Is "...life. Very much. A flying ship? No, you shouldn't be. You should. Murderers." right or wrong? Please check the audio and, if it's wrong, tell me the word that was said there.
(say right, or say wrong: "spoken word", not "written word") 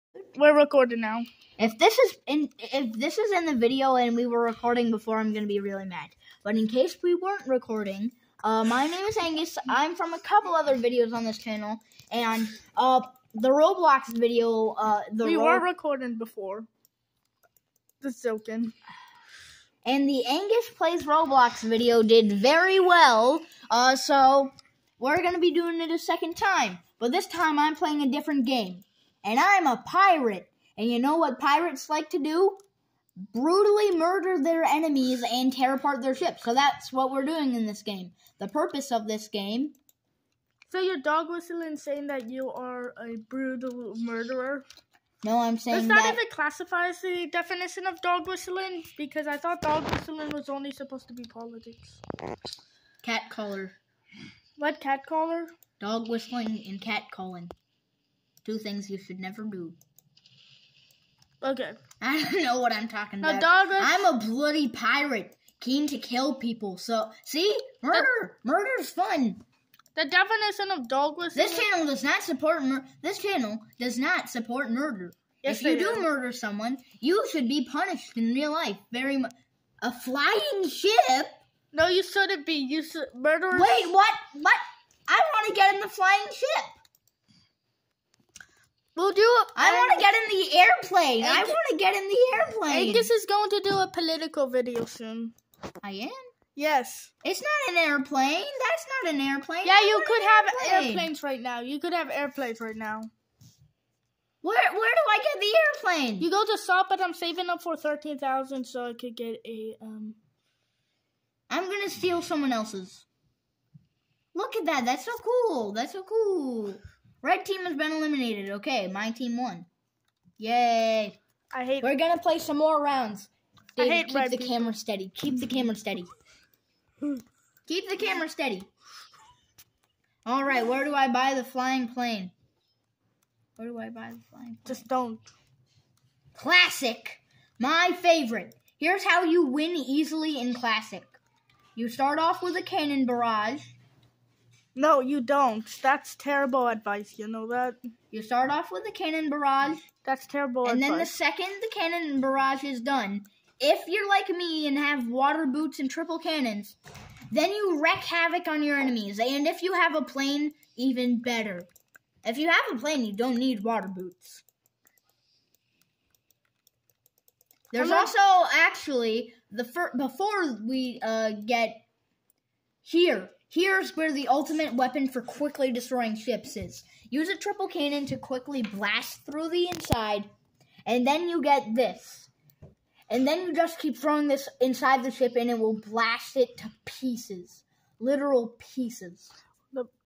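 right.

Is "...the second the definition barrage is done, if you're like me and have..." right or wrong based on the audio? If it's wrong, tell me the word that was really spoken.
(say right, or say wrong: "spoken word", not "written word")
wrong: "cannon", not "definition".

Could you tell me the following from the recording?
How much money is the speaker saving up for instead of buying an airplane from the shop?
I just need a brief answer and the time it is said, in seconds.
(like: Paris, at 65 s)
13,000, at 107 s.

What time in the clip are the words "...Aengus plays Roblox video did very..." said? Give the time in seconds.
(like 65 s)
20 s.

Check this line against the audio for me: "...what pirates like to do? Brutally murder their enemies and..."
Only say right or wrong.
right.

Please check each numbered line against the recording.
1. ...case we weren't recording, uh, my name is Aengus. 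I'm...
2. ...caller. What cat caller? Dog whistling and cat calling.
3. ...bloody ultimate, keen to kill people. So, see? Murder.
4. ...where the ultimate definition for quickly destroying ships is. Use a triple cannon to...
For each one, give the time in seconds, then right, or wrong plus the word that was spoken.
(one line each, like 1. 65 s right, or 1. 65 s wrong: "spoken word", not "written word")
1. 6 s right
2. 53 s right
3. 64 s wrong: "pirate", not "ultimate"
4. 173 s wrong: "weapon", not "definition".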